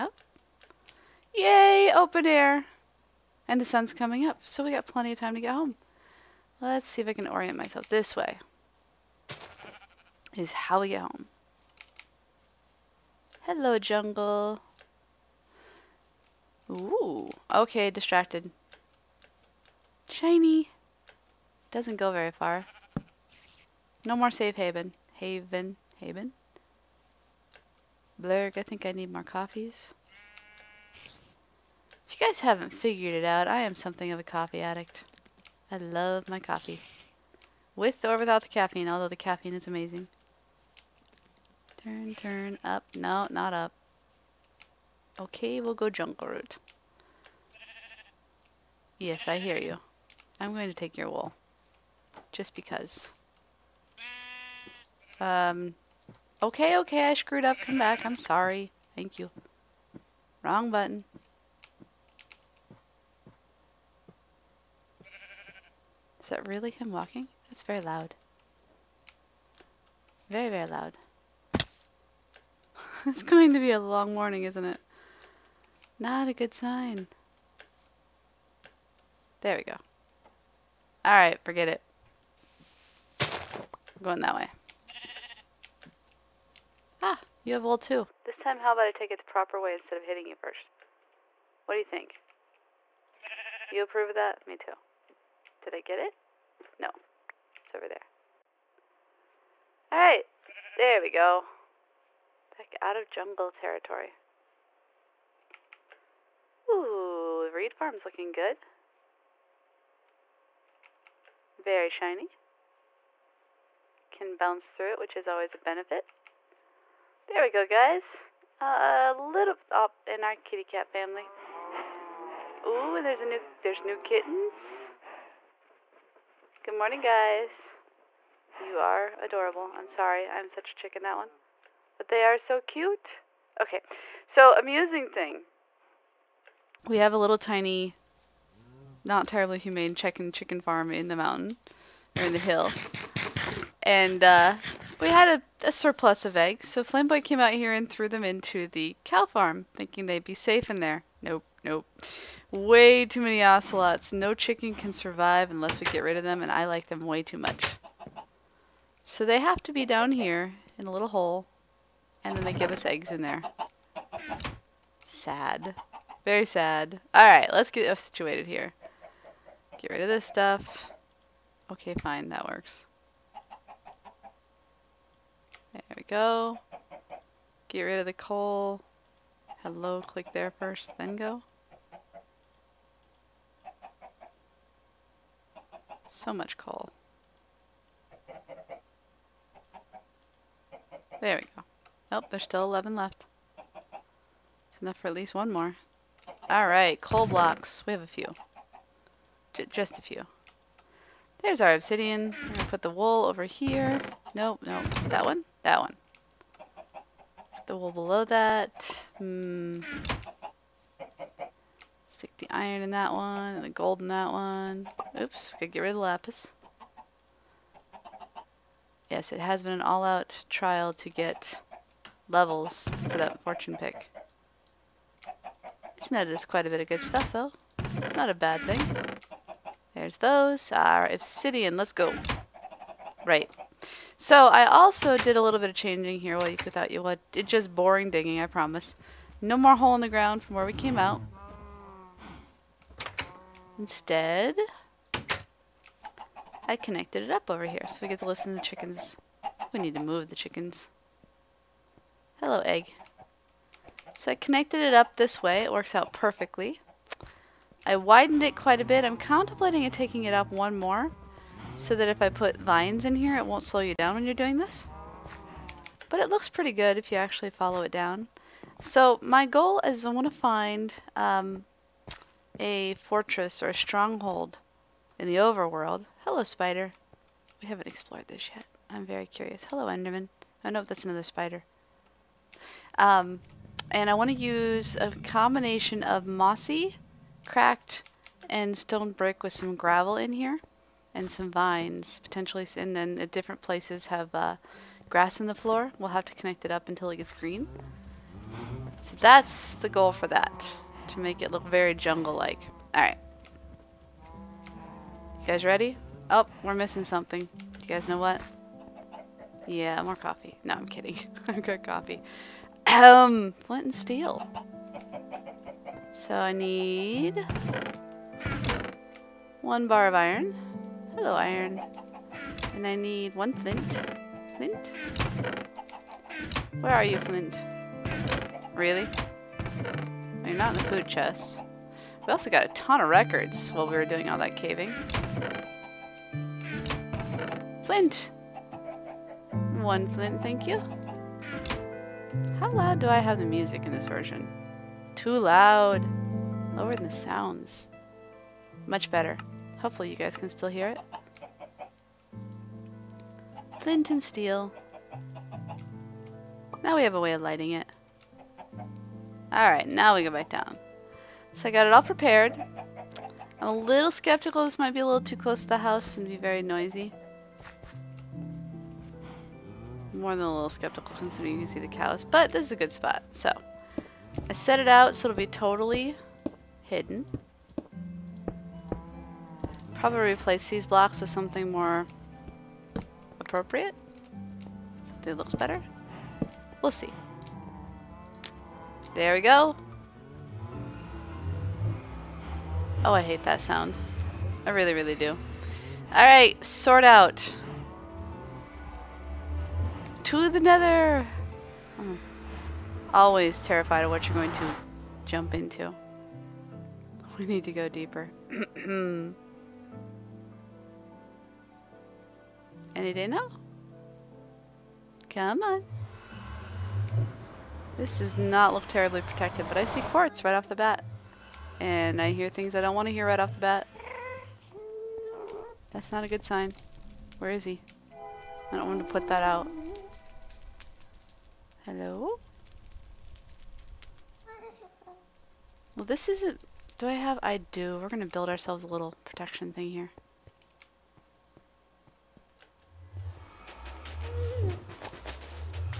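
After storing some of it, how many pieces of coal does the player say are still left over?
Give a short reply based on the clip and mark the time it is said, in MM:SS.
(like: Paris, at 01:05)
11, at 03:12.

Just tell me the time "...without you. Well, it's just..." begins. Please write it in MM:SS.
03:56.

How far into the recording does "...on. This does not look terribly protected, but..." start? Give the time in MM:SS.
06:55.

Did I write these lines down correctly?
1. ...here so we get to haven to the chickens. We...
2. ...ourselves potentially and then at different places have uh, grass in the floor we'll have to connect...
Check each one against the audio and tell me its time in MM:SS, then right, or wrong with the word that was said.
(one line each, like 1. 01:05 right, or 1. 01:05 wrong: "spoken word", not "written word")
1. 04:07 wrong: "listen", not "haven"
2. 04:51 wrong: "vines", not "ourselves".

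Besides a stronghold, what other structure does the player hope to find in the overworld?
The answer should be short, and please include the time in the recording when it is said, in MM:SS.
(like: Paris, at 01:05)
a fortress, at 04:32.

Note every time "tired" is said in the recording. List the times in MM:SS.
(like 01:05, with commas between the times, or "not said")
not said.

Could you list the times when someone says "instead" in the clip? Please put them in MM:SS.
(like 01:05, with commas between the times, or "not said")
01:29, 04:03.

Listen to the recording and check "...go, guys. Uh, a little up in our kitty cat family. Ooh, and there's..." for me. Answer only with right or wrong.
right.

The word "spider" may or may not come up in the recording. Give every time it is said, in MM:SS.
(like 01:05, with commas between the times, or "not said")
04:36, 04:41.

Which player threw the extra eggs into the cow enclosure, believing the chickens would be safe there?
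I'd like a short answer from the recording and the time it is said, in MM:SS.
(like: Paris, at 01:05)
Flamboy, at 02:26.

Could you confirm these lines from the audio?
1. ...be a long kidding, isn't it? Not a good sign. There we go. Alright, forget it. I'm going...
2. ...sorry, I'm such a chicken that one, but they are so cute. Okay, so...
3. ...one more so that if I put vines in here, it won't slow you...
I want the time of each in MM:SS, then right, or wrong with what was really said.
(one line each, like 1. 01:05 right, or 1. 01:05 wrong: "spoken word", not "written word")
1. 01:13 wrong: "morning", not "kidding"
2. 02:09 right
3. 04:20 right.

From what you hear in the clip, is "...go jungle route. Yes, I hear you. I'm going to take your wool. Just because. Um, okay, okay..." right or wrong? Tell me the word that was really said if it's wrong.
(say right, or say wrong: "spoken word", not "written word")
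right.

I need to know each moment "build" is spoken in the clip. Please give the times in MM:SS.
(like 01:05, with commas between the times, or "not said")
07:18.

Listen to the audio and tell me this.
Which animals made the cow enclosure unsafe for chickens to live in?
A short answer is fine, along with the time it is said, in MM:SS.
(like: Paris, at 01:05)
ocelots, at 02:33.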